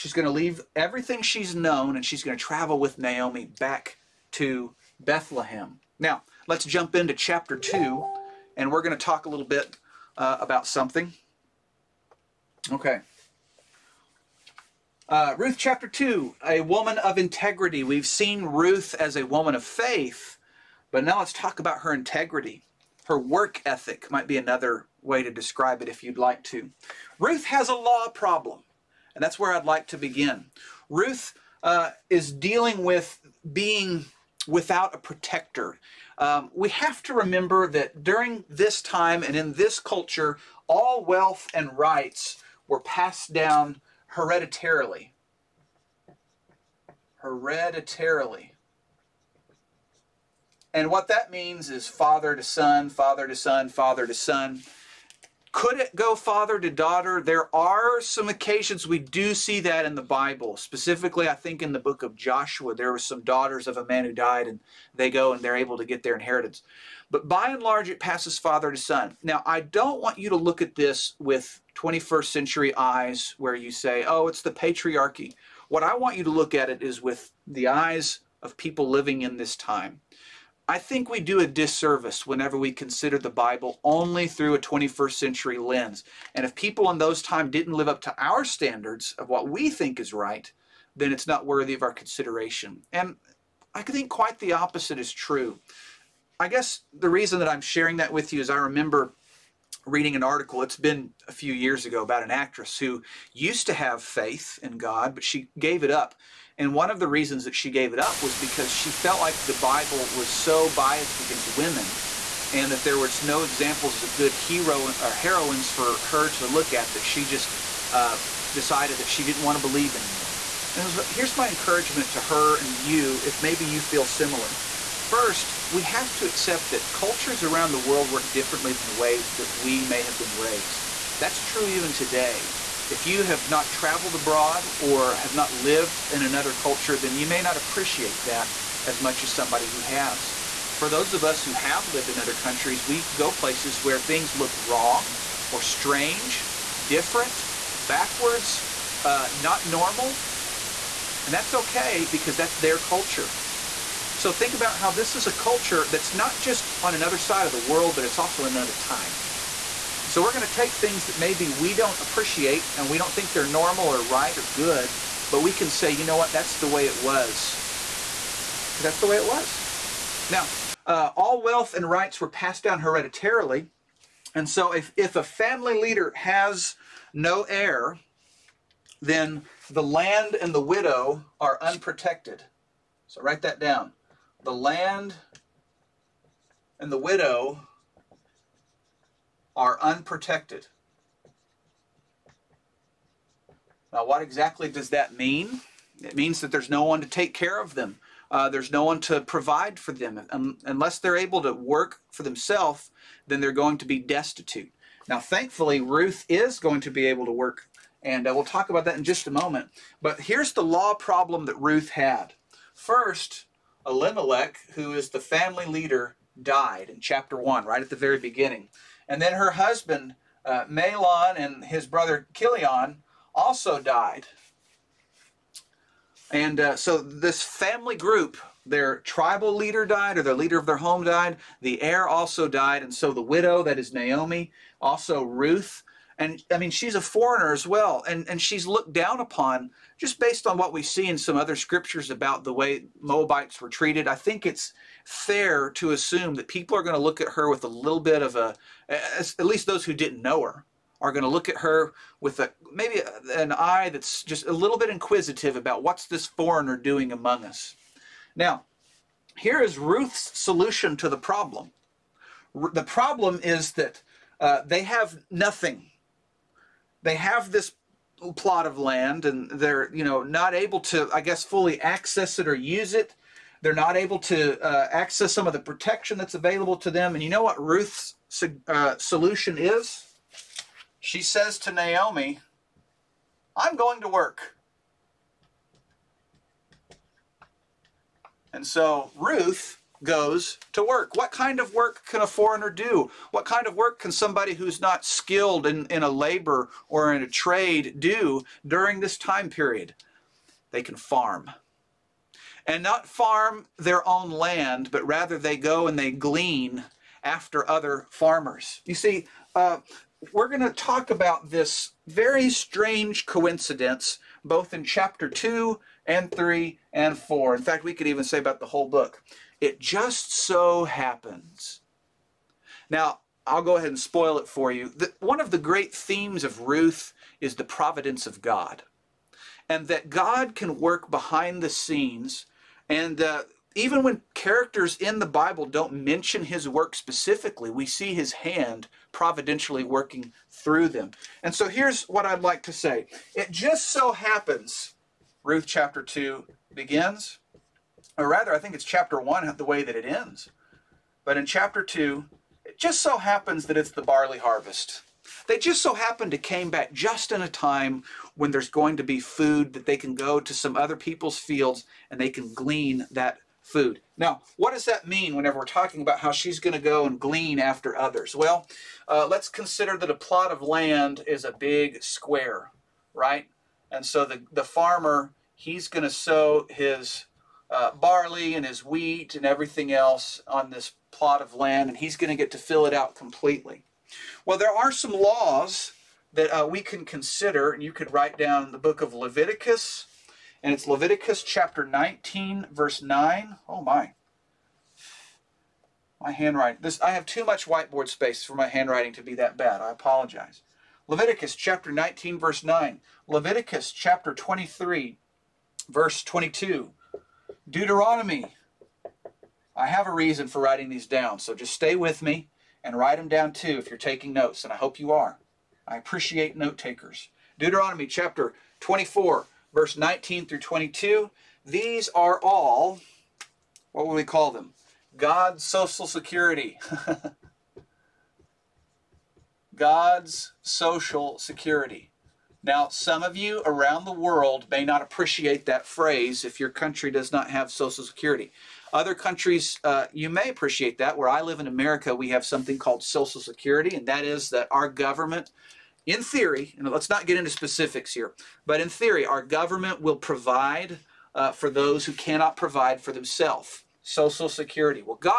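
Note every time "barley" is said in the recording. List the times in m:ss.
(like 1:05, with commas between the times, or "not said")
5:54, 6:17.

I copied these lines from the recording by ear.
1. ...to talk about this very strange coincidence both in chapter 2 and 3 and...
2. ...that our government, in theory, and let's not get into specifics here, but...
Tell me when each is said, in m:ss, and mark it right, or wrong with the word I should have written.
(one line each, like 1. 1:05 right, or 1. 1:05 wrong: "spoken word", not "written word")
1. 5:10 right
2. 7:24 right.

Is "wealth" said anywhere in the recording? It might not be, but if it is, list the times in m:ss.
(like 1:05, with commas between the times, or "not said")
0:41, 2:51.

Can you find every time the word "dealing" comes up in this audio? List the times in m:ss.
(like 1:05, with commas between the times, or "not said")
0:32.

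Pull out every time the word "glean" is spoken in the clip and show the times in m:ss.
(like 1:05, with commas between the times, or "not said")
5:06, 6:02, 6:07.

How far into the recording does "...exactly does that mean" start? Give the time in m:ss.
3:14.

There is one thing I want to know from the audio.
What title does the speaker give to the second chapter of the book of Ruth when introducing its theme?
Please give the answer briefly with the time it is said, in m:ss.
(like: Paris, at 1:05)
A woman of integrity, at 0:16.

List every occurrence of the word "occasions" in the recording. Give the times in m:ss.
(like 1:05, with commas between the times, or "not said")
0:58.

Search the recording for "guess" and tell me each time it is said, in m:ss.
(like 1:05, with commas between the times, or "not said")
1:36, 4:31.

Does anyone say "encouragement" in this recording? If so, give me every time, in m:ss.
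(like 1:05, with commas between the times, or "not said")
2:01.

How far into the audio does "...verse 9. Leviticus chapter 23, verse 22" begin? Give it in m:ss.
6:42.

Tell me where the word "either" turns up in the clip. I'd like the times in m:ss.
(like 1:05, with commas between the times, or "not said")
not said.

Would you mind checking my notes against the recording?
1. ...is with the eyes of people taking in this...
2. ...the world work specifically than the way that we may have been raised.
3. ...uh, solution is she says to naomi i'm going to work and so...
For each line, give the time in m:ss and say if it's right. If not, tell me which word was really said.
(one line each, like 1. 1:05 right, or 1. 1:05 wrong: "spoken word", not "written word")
1. 1:16 wrong: "living", not "taking"
2. 2:07 wrong: "differently", not "specifically"
3. 4:38 right.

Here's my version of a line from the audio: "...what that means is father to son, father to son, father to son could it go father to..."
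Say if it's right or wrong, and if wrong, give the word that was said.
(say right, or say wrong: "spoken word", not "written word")
right.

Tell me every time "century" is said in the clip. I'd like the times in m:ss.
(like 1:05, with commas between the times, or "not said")
1:12, 1:25.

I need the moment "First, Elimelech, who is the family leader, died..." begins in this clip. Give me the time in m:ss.
3:32.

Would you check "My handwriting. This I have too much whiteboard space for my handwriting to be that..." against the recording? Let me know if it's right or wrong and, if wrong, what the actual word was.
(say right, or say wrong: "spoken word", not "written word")
right.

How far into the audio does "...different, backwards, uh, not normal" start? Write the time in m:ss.
2:26.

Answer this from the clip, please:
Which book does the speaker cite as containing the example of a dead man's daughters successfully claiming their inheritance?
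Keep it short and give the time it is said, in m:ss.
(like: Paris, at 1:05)
Joshua, at 1:01.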